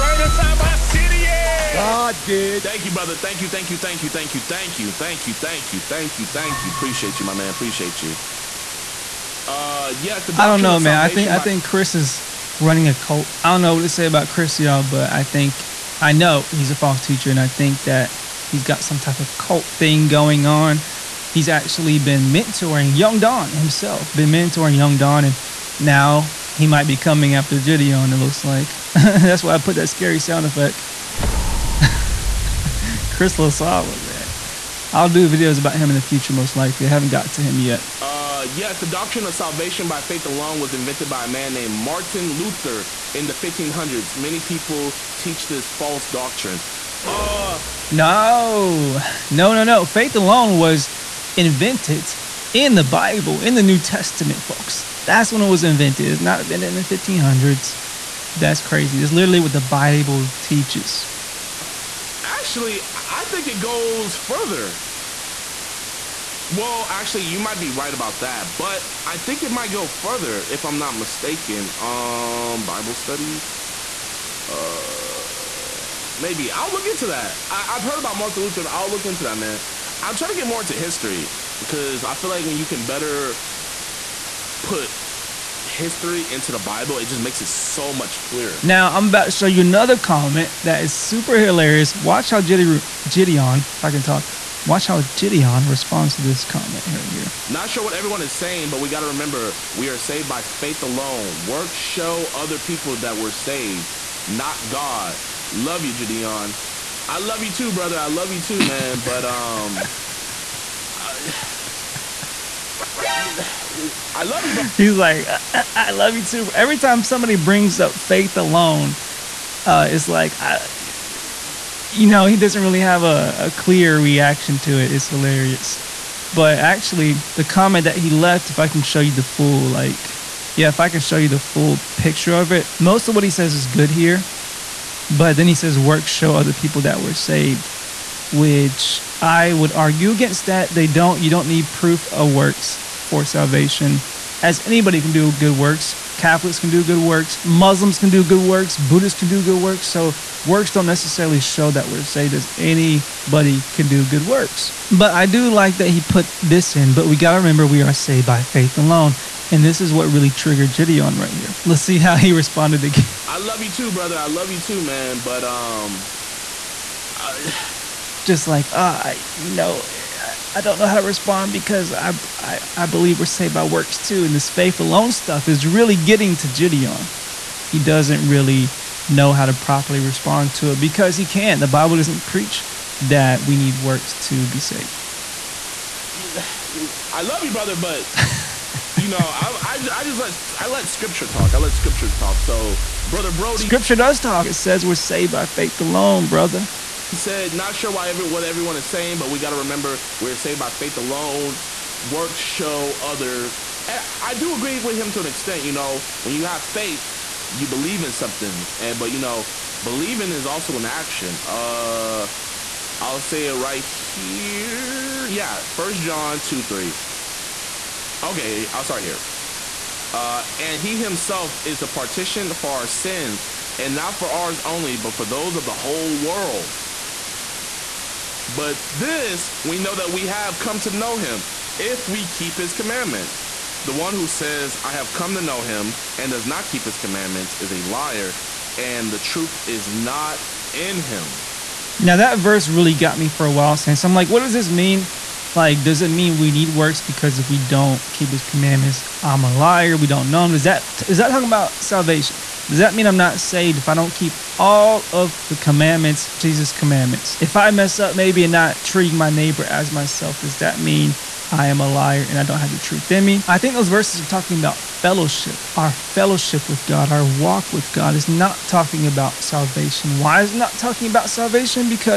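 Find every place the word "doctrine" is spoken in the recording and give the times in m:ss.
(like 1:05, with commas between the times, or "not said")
0:38, 0:46.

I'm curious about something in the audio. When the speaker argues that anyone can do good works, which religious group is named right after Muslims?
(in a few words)
Buddhists.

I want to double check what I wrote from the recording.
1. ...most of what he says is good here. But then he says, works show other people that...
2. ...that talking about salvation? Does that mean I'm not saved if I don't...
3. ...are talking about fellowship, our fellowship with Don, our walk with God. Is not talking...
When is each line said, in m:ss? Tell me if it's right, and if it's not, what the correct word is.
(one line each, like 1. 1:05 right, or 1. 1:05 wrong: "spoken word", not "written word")
1. 2:12 right
2. 4:11 right
3. 4:24 wrong: "God", not "Don".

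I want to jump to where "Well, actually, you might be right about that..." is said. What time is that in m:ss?
1:06.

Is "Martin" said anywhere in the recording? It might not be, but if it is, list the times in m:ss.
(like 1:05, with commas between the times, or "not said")
0:41, 1:18.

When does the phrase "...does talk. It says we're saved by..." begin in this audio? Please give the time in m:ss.
3:13.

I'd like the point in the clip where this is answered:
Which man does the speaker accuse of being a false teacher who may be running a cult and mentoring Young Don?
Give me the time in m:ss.
0:33.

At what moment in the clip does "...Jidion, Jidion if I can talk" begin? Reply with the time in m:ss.
1:32.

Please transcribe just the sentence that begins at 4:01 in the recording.
Now that verse really got me for a while since I'm like, what does this mean?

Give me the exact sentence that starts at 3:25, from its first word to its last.
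You know, when you have faith, you believe in something, and but you know, believing is also an action.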